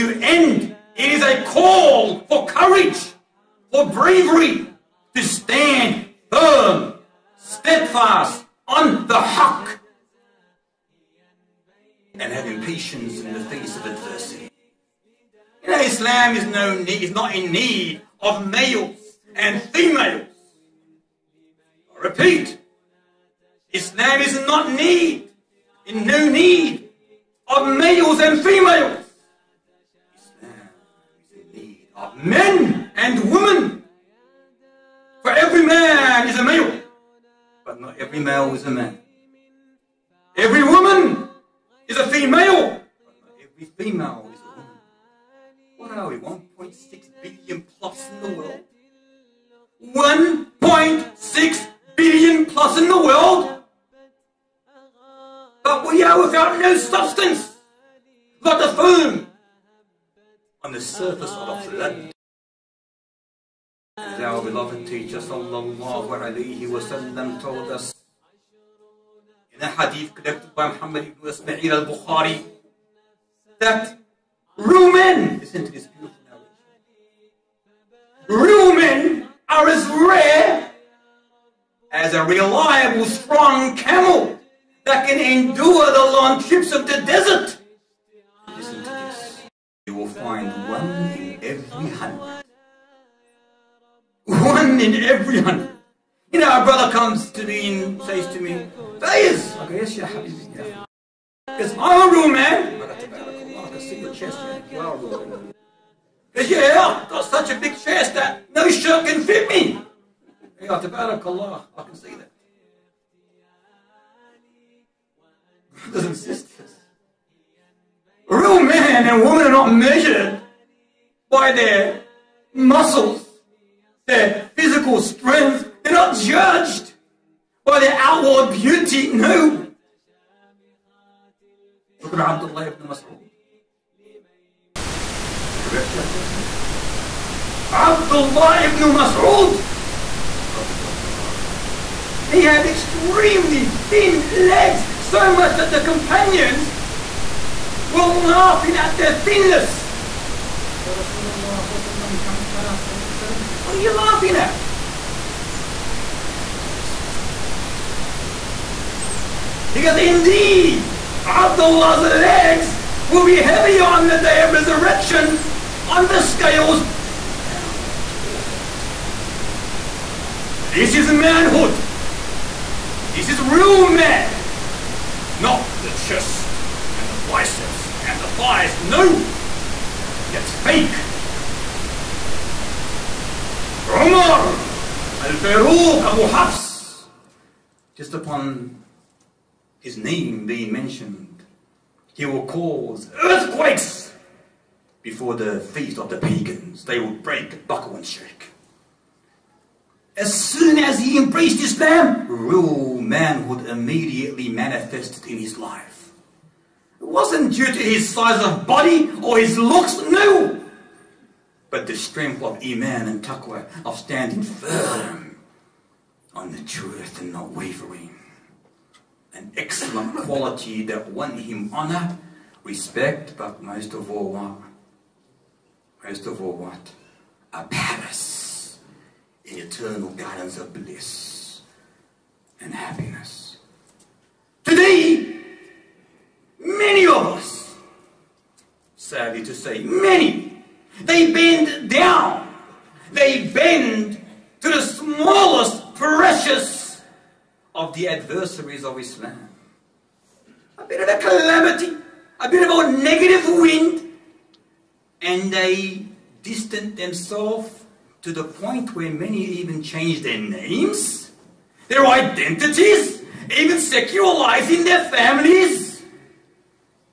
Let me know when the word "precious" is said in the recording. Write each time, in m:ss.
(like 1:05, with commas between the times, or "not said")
4:05.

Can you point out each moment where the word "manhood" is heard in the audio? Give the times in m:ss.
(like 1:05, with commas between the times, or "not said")
2:51, 3:22.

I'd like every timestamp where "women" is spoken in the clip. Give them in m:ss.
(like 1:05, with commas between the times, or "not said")
0:33, 1:59.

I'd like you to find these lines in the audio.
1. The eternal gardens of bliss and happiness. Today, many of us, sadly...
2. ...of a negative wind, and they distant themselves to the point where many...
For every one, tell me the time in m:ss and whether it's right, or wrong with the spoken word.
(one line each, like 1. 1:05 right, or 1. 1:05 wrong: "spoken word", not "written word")
1. 3:49 right
2. 4:12 right.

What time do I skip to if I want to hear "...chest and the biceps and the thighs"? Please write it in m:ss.
2:55.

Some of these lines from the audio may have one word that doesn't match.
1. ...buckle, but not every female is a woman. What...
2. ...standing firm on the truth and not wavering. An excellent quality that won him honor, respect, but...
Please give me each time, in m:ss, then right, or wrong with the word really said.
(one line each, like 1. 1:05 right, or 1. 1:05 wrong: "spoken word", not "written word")
1. 0:42 wrong: "female", not "buckle"
2. 3:33 right.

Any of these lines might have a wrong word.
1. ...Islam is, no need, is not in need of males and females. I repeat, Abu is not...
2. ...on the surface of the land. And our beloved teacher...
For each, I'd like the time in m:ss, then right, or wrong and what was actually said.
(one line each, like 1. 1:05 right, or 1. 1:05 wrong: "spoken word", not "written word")
1. 0:15 wrong: "Islam", not "Abu"
2. 1:00 right.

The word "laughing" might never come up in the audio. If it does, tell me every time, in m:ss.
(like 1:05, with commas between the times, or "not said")
2:28, 2:33.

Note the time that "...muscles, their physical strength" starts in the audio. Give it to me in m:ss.
2:02.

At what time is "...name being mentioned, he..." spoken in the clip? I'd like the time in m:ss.
3:09.